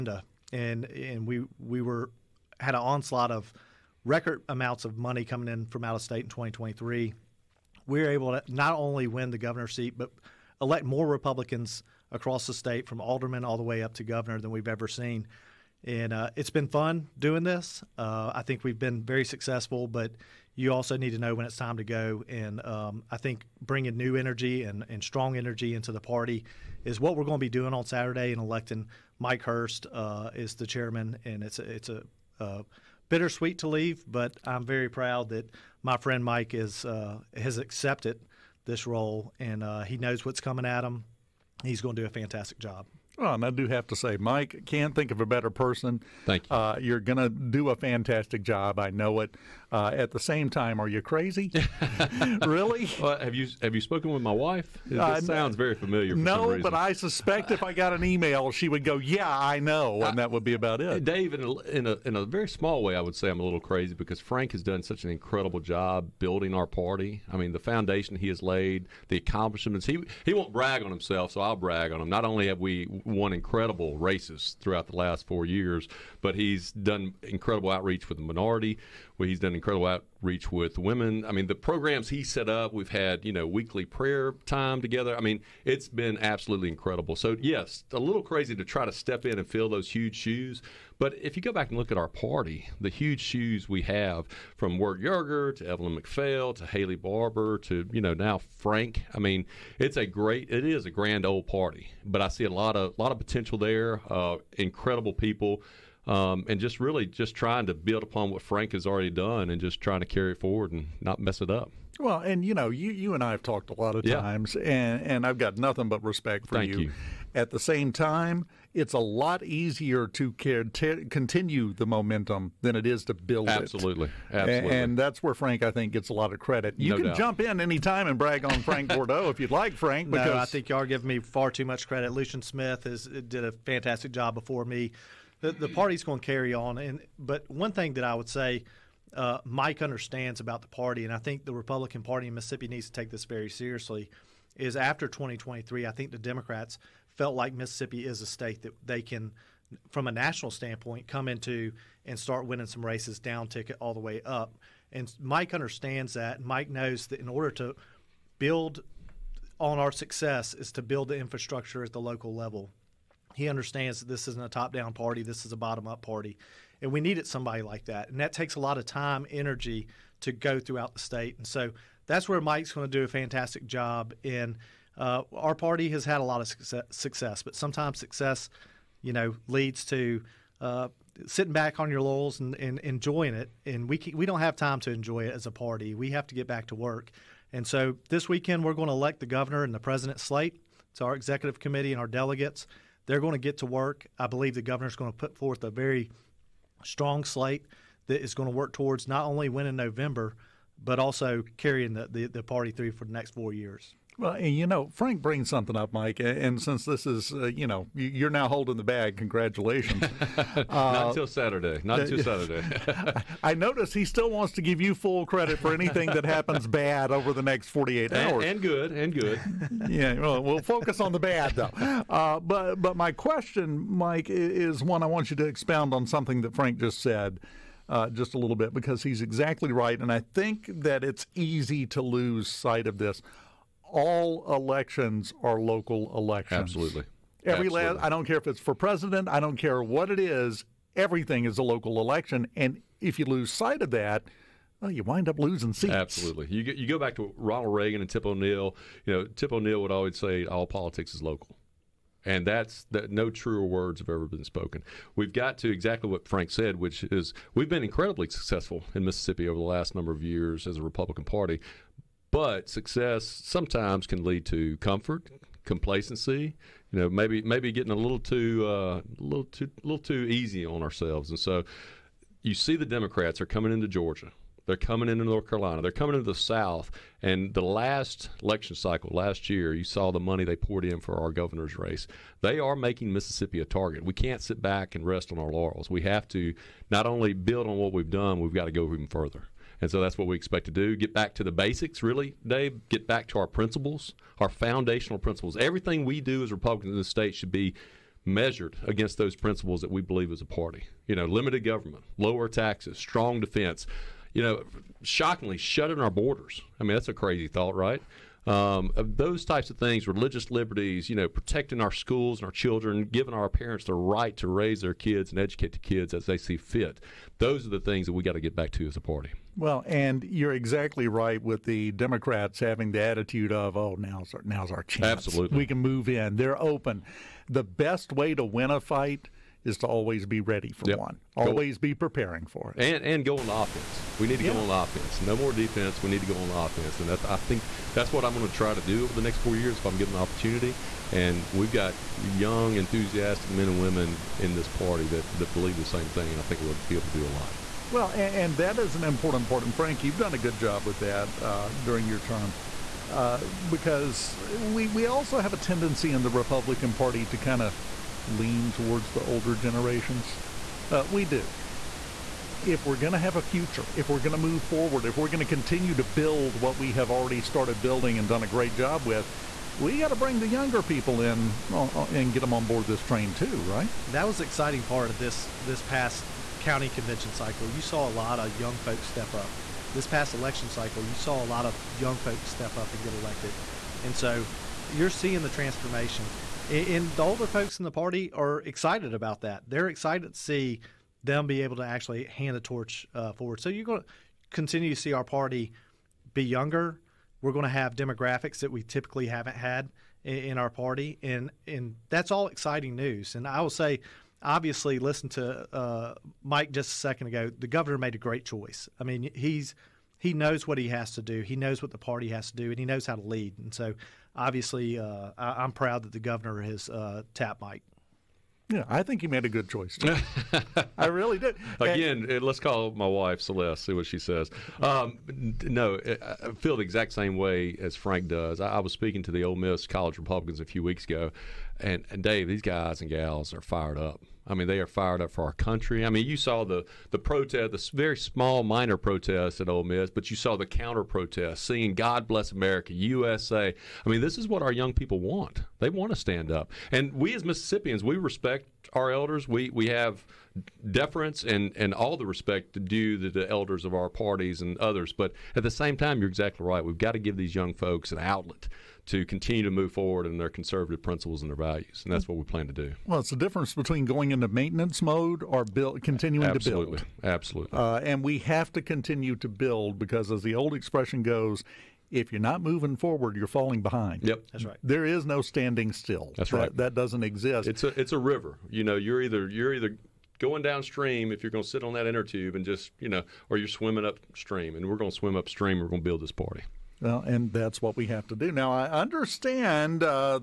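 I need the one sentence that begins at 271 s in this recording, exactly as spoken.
And so, you see, the Democrats are coming into Georgia.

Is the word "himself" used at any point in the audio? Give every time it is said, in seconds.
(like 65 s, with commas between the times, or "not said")
70 s.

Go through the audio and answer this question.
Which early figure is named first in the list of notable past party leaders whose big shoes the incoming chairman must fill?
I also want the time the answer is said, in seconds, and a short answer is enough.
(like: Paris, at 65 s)
Wirt Yerger, at 94 s.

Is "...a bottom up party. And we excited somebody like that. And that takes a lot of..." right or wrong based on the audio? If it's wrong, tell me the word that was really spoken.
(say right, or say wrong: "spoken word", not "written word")
wrong: "needed", not "excited".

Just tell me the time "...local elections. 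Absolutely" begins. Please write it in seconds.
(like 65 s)
235 s.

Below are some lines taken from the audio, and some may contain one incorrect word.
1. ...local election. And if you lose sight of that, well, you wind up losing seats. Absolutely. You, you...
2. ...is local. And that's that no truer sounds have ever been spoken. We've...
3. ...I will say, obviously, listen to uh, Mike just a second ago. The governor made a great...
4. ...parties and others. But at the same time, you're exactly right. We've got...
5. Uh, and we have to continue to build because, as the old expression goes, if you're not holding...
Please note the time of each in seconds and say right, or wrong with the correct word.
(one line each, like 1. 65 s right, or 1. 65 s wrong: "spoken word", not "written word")
1. 241 s right
2. 251 s wrong: "words", not "sounds"
3. 403 s right
4. 454 s right
5. 467 s wrong: "moving", not "holding".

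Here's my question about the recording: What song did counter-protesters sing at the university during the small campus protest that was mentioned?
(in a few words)
God Bless America.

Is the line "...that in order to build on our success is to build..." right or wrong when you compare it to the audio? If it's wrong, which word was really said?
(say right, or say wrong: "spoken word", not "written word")
right.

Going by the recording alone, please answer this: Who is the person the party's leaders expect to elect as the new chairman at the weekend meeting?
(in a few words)
Mike Hurst.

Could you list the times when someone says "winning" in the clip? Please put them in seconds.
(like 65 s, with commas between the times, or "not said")
152 s, 199 s.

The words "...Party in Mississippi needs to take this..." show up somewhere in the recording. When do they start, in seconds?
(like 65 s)
142 s.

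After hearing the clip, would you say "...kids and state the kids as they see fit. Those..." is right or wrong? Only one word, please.
wrong.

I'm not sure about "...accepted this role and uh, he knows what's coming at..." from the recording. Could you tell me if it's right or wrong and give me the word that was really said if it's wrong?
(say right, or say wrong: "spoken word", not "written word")
right.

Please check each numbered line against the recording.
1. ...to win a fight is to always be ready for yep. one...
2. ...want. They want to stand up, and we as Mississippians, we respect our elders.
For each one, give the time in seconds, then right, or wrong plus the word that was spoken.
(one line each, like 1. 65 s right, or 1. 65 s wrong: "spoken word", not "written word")
1. 328 s right
2. 445 s right.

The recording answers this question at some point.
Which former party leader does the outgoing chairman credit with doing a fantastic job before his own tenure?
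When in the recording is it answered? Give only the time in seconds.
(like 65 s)
132 s.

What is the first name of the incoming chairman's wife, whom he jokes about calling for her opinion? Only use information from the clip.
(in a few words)
Celeste.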